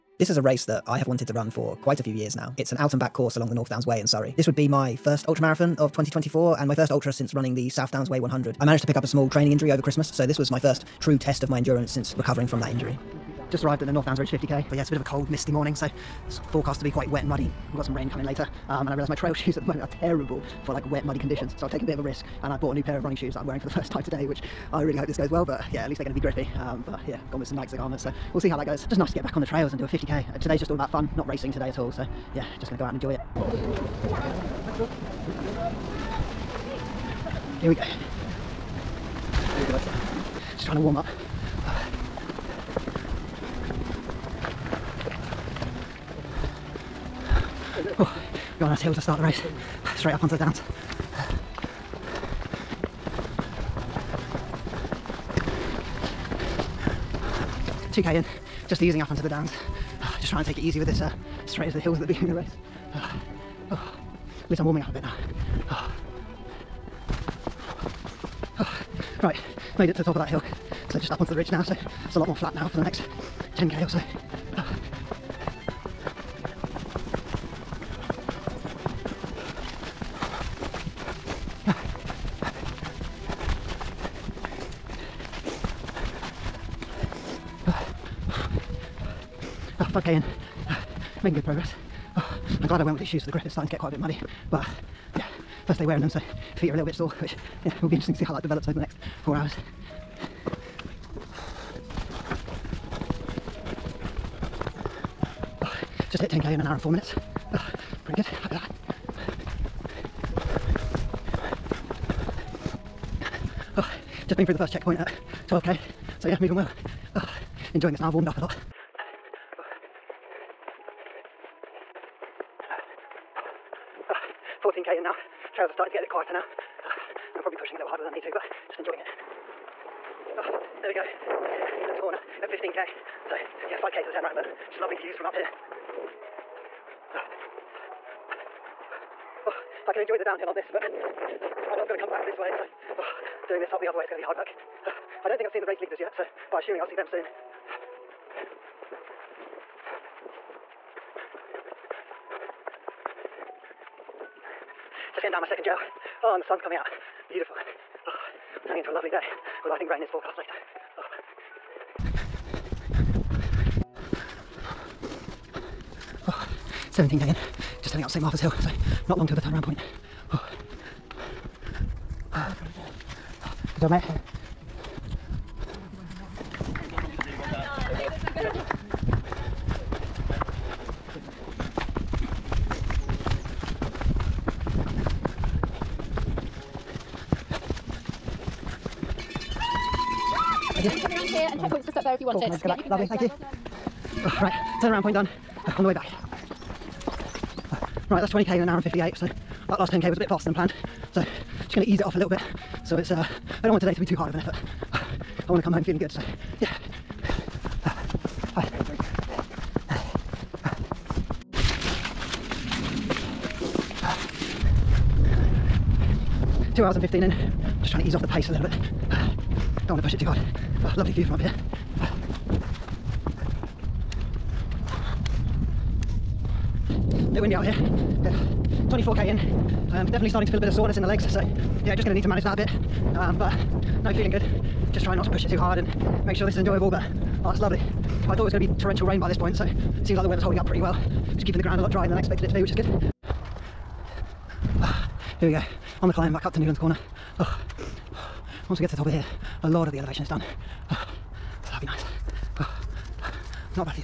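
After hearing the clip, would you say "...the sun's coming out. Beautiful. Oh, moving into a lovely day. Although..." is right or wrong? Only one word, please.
wrong.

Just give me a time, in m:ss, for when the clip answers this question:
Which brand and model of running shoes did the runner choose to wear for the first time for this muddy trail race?
0:27.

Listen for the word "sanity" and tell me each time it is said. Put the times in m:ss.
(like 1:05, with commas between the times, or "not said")
not said.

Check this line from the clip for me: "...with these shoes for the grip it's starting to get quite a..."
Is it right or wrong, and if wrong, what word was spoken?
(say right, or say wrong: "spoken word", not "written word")
right.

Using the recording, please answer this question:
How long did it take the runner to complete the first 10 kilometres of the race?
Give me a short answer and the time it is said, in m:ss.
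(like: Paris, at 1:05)
1 hour 4 minutes, at 1:46.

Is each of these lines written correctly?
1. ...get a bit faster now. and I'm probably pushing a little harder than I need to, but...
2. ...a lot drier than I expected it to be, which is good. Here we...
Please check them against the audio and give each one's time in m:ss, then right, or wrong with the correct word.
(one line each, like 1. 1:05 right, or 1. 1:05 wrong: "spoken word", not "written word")
1. 2:05 wrong: "quieter", not "faster"
2. 4:01 right.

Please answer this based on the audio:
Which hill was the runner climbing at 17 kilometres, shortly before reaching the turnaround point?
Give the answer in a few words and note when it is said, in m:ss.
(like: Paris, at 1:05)
St Martha's Hill, at 2:48.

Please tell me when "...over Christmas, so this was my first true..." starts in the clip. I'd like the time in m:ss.
0:09.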